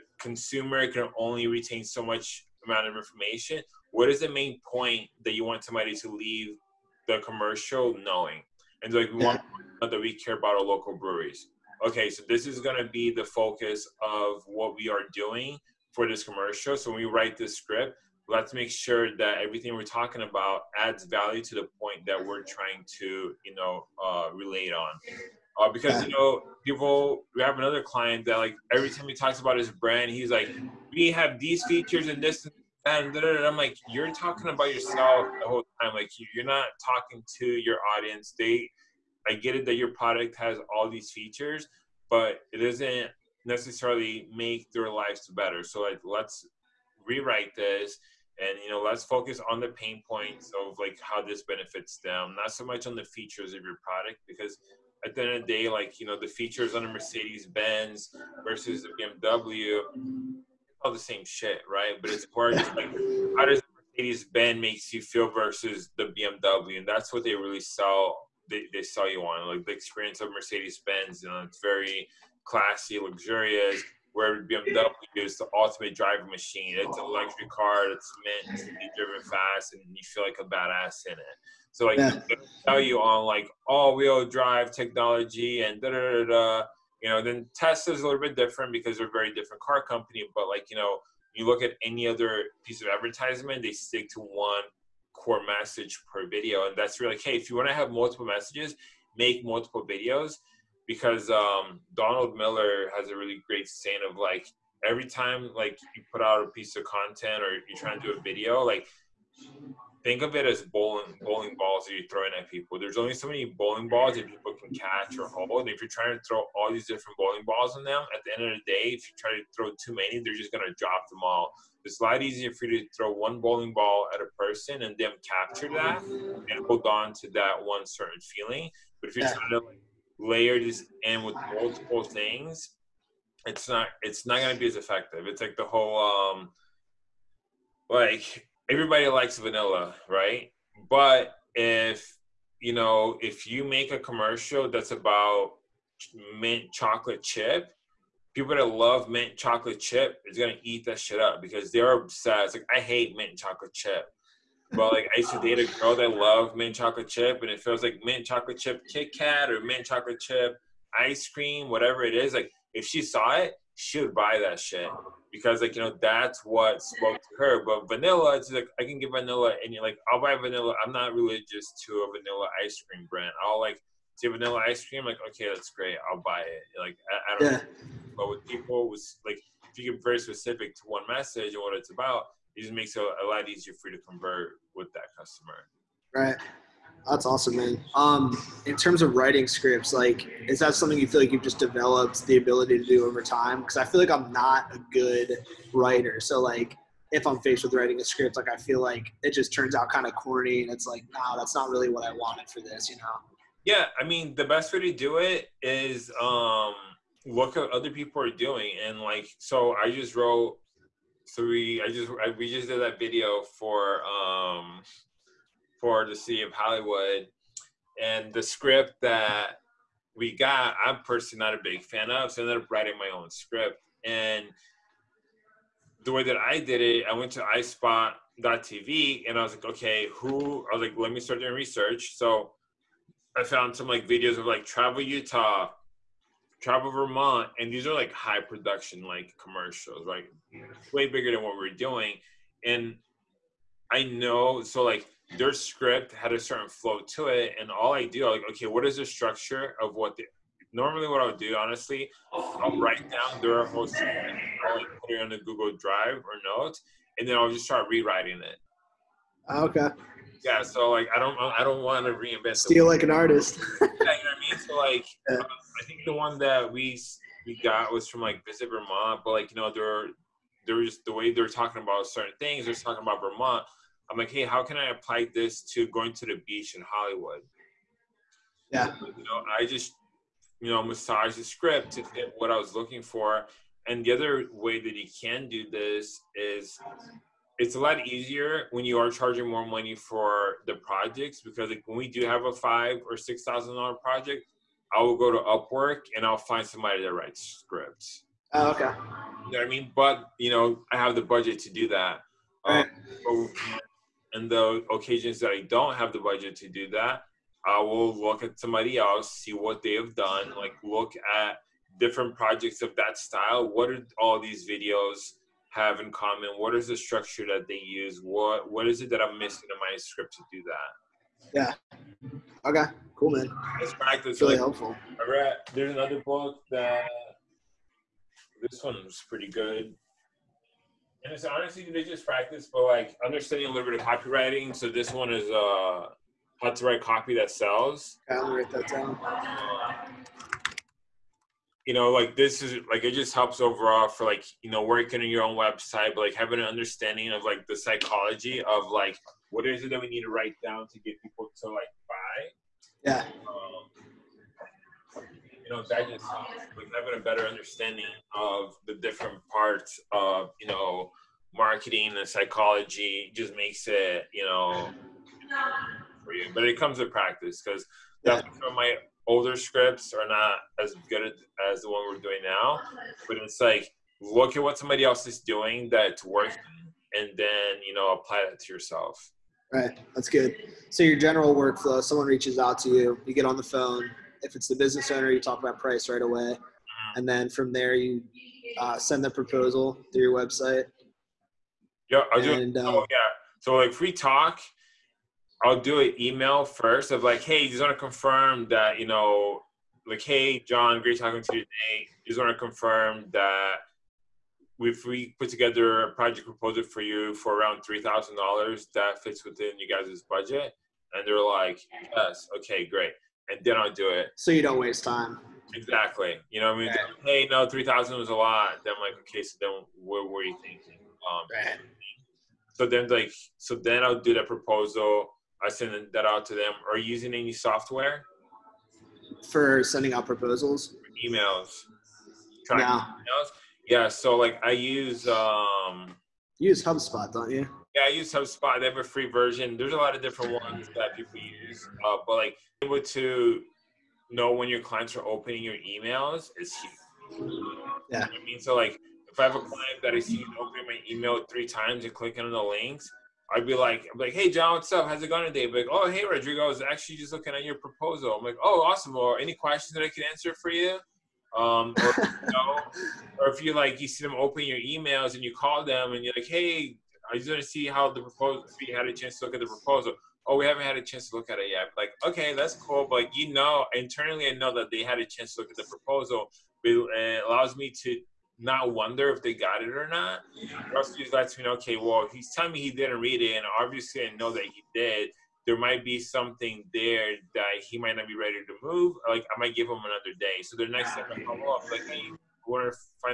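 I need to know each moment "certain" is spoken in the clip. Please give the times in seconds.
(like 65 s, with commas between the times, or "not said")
127 s, 246 s, 272 s.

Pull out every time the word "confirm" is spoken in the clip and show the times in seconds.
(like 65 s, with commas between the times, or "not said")
397 s, 402 s.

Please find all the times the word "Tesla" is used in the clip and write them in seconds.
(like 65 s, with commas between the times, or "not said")
87 s.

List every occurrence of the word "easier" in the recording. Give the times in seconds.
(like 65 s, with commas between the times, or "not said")
122 s, 183 s, 288 s.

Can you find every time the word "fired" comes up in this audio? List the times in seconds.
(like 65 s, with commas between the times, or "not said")
not said.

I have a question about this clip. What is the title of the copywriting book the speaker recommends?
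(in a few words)
How to Write Copy That Sells.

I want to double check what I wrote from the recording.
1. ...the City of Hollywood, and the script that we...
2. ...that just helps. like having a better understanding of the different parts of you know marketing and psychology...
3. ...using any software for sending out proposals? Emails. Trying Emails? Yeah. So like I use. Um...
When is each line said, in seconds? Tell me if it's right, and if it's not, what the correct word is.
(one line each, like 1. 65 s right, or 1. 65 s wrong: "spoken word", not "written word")
1. 216 s right
2. 355 s right
3. 427 s right.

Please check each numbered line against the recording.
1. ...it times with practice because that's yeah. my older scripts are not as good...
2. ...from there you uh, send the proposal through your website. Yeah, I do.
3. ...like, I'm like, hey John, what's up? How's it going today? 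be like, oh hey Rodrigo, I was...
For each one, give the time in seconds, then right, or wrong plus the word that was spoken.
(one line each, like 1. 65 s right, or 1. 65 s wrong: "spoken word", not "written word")
1. 366 s wrong: "comes", not "times"
2. 387 s right
3. 453 s right.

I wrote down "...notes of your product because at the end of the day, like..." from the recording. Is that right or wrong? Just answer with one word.
wrong.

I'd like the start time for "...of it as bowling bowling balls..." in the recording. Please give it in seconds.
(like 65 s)
110 s.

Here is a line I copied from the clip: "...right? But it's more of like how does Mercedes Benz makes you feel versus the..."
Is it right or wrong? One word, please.
right.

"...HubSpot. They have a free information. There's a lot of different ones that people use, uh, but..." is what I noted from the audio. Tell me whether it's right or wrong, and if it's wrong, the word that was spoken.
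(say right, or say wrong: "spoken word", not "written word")
wrong: "version", not "information".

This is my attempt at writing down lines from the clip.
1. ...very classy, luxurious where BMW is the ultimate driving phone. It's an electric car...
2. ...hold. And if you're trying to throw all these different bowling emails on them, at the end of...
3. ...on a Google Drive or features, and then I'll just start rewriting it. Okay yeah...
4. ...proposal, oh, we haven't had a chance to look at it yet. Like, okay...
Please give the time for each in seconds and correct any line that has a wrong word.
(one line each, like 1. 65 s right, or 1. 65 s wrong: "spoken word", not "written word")
1. 71 s wrong: "machine", not "phone"
2. 115 s wrong: "balls", not "emails"
3. 255 s wrong: "notes", not "features"
4. 469 s right.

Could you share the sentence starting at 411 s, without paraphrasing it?
And they're like, yes, okay, great.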